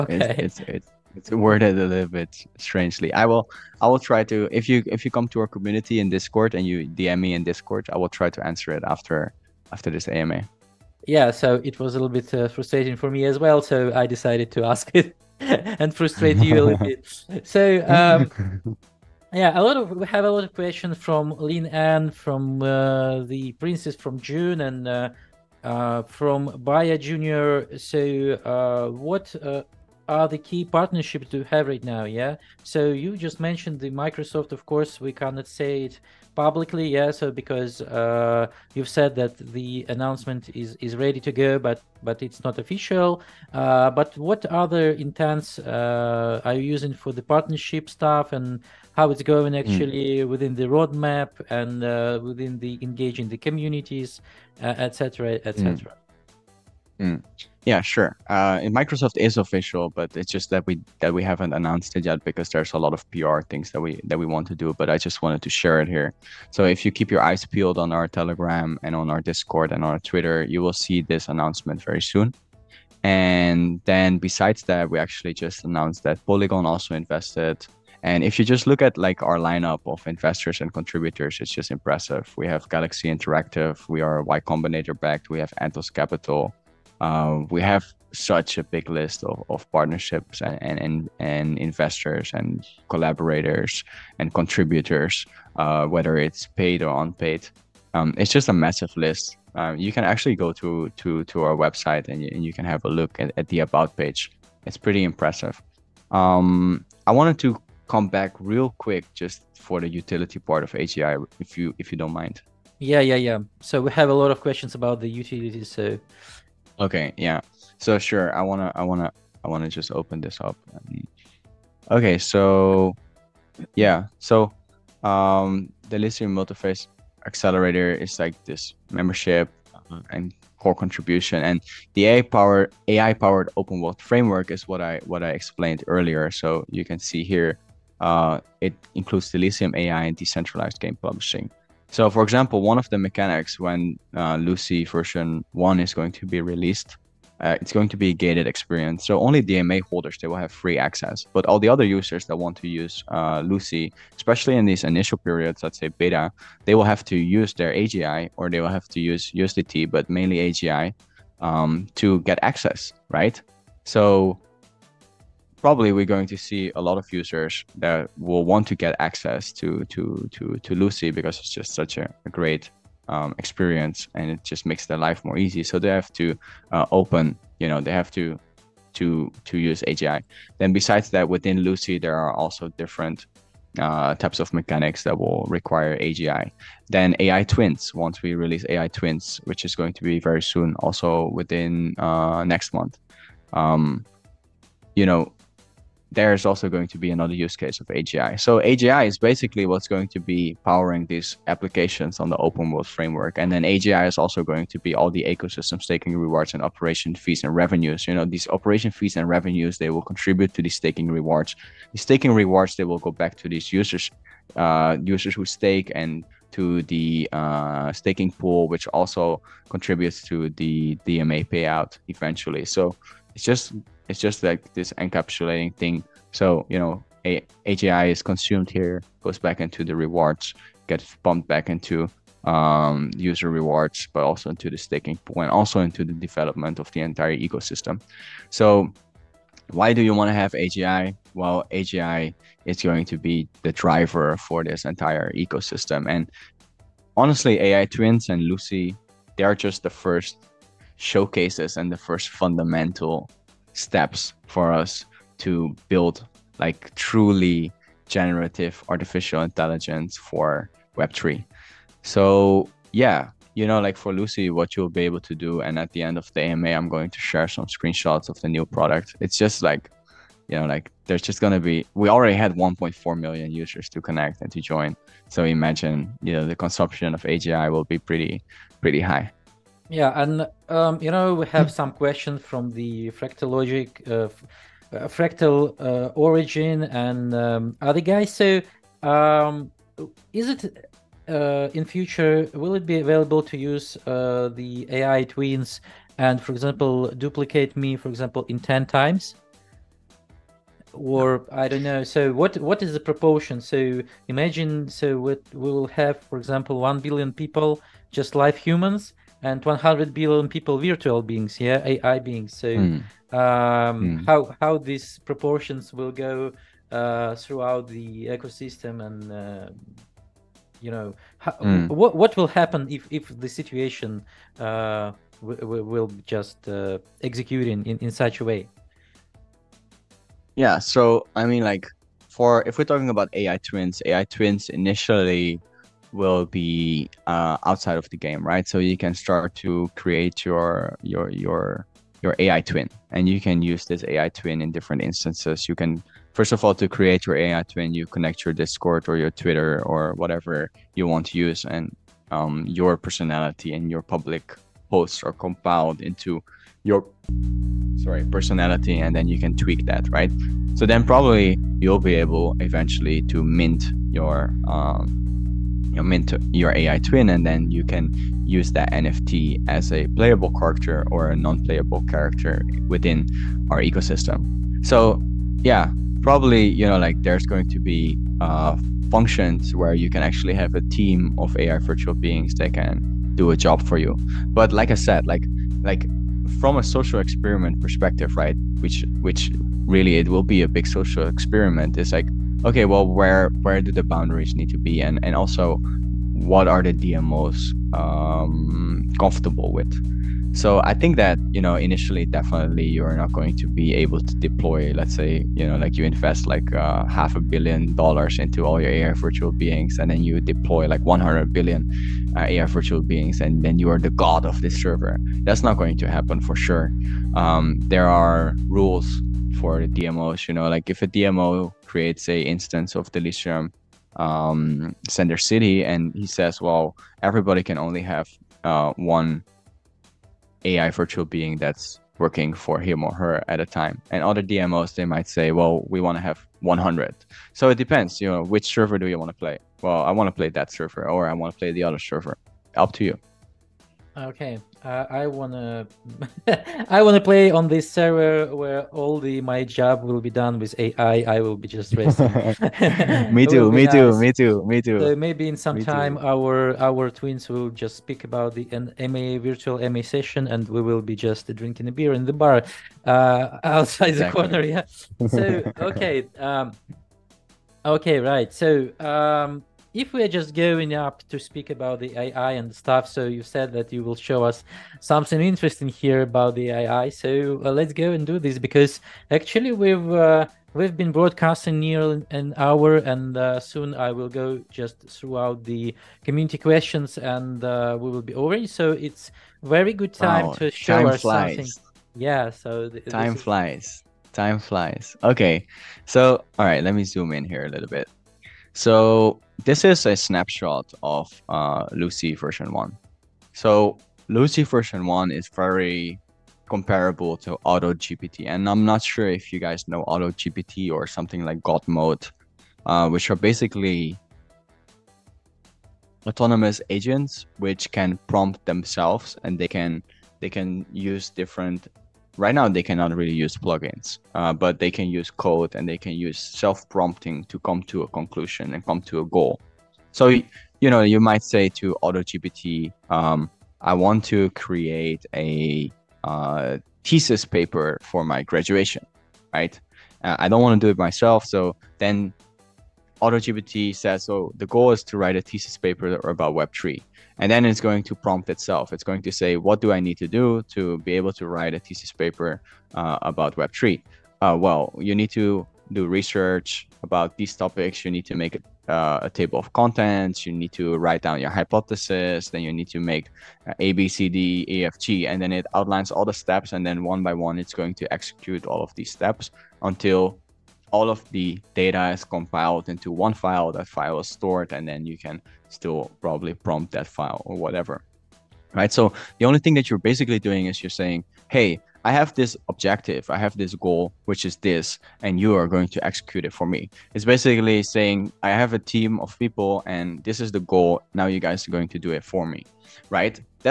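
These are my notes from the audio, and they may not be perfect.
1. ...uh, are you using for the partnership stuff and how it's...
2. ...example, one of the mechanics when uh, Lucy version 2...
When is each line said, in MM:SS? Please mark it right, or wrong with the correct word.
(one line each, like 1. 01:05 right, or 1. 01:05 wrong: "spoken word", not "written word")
1. 00:45 right
2. 02:22 wrong: "1", not "2".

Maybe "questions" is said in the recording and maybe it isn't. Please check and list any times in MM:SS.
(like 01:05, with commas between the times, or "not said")
00:20, 01:54, 04:41, 08:06.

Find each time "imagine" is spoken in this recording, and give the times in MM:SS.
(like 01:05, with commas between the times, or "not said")
04:35, 05:04.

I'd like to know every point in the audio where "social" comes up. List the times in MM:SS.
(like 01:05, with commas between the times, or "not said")
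06:26, 06:30.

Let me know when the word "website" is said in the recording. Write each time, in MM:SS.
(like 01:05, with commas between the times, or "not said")
01:41.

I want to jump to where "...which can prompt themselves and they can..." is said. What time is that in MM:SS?
08:37.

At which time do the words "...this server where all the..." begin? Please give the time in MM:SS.
07:27.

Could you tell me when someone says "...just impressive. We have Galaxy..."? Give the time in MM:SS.
01:21.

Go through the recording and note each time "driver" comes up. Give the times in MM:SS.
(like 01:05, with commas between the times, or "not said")
04:03.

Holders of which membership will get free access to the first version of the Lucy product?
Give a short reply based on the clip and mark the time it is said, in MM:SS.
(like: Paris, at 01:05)
DMA holders, at 02:29.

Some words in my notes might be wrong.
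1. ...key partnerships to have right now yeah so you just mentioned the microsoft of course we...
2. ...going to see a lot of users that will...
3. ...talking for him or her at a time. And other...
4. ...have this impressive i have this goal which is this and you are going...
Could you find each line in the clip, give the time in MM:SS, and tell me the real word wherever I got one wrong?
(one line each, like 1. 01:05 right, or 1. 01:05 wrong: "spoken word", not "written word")
1. 00:30 right
2. 02:46 right
3. 07:12 wrong: "working", not "talking"
4. 09:42 wrong: "objective", not "impressive".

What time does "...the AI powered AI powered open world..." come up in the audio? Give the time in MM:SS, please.
02:11.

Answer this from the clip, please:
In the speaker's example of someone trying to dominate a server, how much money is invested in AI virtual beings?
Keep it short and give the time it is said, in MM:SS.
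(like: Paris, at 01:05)
half a billion dollars, at 06:47.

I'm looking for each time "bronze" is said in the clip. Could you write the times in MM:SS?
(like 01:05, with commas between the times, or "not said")
not said.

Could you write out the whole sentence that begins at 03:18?
So AGI is basically what's going to be powering these applications on the open world framework.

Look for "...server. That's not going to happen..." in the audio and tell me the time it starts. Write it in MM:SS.
06:54.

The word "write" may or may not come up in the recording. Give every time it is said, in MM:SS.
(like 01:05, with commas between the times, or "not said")
09:05, 09:11, 09:20.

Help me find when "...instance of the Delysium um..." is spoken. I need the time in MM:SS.
07:02.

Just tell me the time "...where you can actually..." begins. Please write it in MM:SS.
06:19.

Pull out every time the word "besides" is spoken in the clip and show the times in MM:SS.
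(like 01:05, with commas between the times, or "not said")
01:14, 03:00.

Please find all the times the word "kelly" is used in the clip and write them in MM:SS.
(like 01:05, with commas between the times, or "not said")
not said.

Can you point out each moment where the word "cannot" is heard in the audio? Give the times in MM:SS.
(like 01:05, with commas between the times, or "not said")
00:35, 08:42.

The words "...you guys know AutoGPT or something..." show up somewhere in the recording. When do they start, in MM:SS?
08:29.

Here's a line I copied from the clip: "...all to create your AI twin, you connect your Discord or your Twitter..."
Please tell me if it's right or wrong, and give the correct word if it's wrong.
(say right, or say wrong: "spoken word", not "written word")
right.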